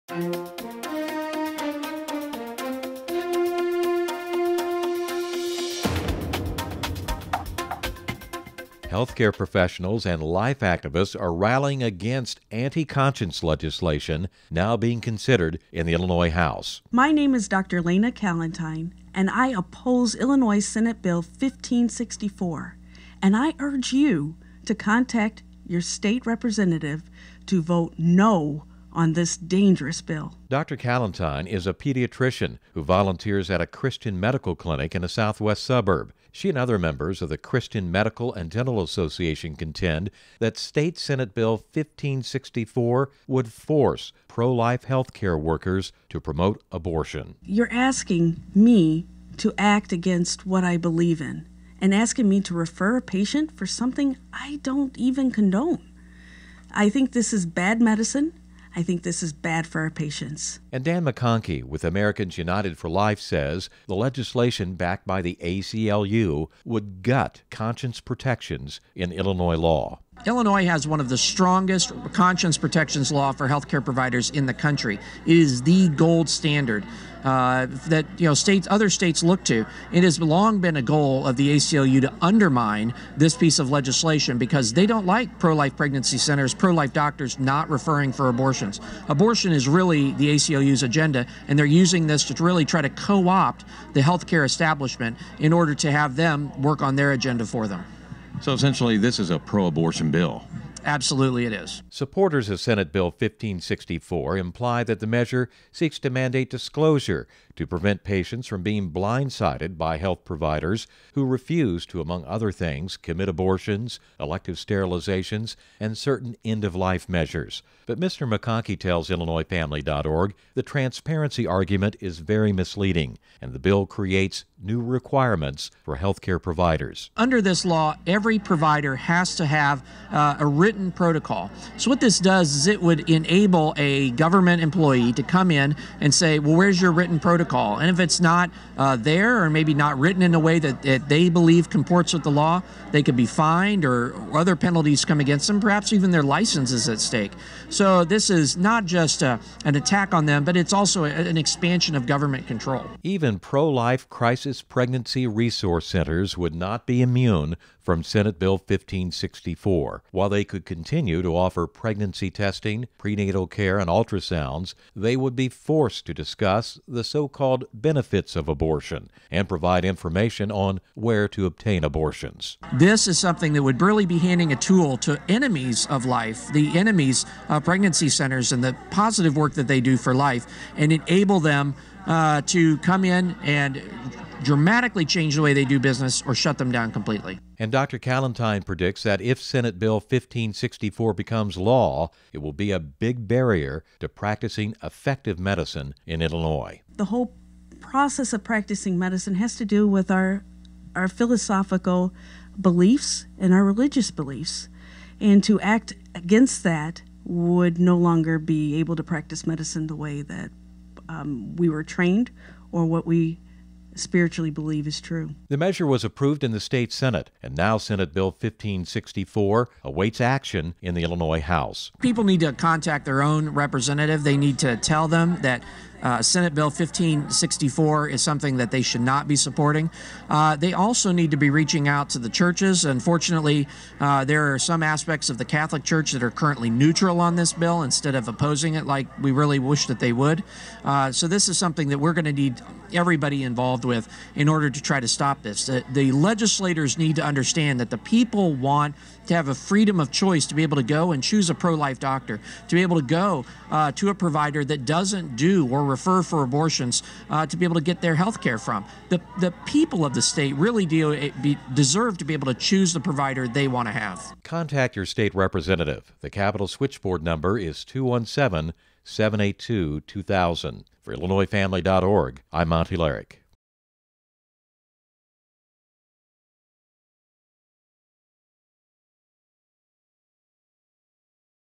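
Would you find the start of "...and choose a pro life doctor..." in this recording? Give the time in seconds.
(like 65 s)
251 s.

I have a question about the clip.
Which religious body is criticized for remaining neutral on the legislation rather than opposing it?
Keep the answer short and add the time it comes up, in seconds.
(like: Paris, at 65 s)
Catholic Church, at 235 s.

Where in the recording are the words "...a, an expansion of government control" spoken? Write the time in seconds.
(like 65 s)
151 s.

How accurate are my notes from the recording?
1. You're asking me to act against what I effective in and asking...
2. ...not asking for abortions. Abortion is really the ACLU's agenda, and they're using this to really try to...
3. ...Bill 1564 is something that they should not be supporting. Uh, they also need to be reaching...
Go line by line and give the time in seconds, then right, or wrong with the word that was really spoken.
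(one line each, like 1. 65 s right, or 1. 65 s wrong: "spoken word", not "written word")
1. 47 s wrong: "believe", not "effective"
2. 87 s wrong: "referring", not "asking"
3. 226 s right.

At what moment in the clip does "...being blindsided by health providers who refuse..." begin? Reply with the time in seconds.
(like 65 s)
108 s.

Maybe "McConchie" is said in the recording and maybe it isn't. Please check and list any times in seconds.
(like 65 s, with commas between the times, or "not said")
61 s, 118 s.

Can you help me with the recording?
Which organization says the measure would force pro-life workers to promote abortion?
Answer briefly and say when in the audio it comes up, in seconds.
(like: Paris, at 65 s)
Christian Medical and Dental Association, at 37 s.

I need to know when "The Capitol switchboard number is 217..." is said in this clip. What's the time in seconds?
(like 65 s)
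266 s.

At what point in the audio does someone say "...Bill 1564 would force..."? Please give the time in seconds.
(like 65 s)
41 s.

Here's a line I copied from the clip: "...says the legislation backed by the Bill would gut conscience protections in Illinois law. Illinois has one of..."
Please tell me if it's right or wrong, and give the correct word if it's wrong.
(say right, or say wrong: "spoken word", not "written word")
wrong: "ACLU", not "Bill".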